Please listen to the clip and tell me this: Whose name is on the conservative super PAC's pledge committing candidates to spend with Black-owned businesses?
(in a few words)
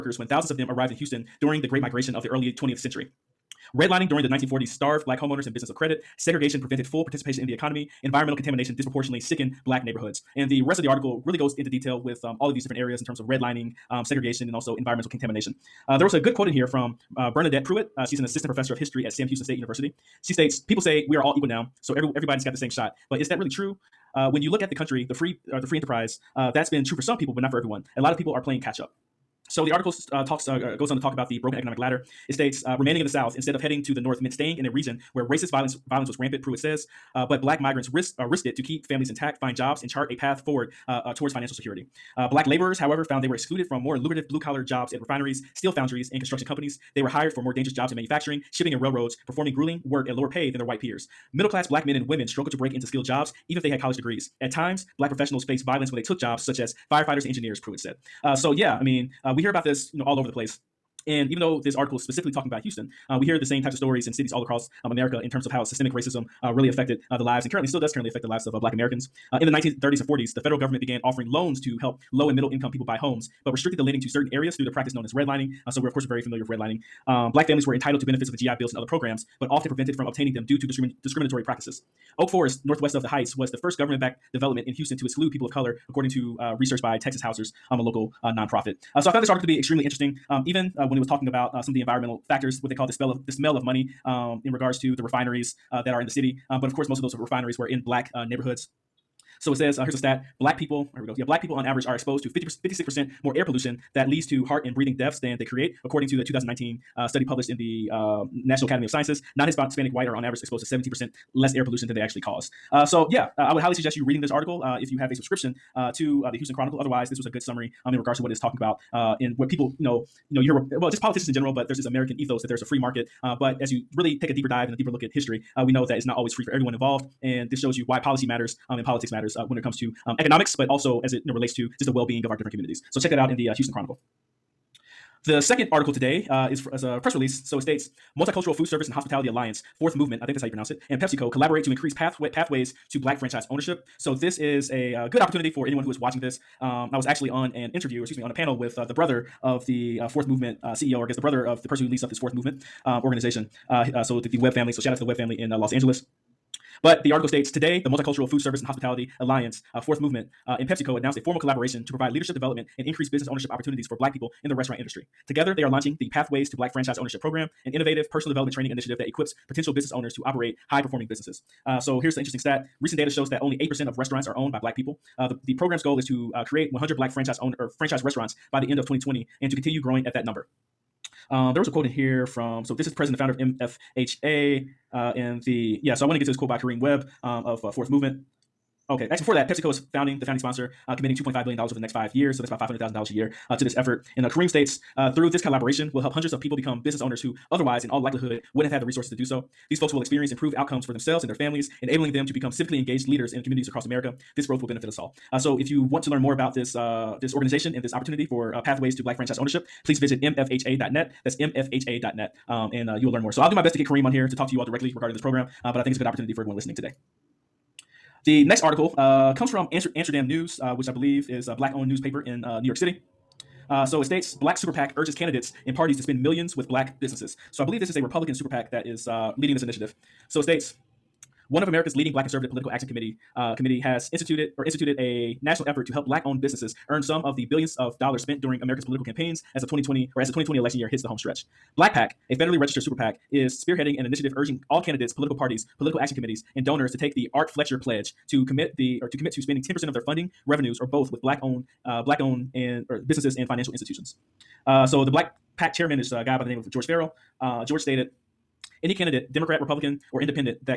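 Art Fletcher.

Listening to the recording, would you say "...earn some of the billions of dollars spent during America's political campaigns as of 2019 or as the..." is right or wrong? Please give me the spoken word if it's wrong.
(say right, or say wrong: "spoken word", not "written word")
wrong: "2020", not "2019".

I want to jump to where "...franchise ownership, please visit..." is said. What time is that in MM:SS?
03:29.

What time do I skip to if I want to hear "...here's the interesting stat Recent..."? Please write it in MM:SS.
02:51.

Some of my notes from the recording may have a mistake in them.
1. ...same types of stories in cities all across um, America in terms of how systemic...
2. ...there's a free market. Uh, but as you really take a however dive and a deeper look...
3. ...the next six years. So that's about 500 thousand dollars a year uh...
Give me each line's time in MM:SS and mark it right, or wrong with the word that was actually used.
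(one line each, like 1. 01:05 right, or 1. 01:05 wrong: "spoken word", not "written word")
1. 01:03 right
2. 02:02 wrong: "deeper", not "however"
3. 03:11 wrong: "five", not "six".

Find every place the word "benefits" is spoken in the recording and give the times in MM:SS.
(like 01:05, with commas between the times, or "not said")
01:18, 03:24.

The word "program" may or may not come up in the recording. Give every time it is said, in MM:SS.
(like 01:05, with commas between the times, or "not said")
01:18, 02:47, 02:55, 03:35.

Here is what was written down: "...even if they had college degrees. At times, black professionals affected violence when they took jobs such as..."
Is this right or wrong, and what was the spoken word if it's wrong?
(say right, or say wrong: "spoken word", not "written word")
wrong: "faced", not "affected".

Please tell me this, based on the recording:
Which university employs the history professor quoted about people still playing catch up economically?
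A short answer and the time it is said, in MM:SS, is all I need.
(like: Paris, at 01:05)
Sam Houston State University, at 00:19.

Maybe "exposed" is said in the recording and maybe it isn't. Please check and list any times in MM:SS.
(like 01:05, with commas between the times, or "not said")
01:41, 01:50.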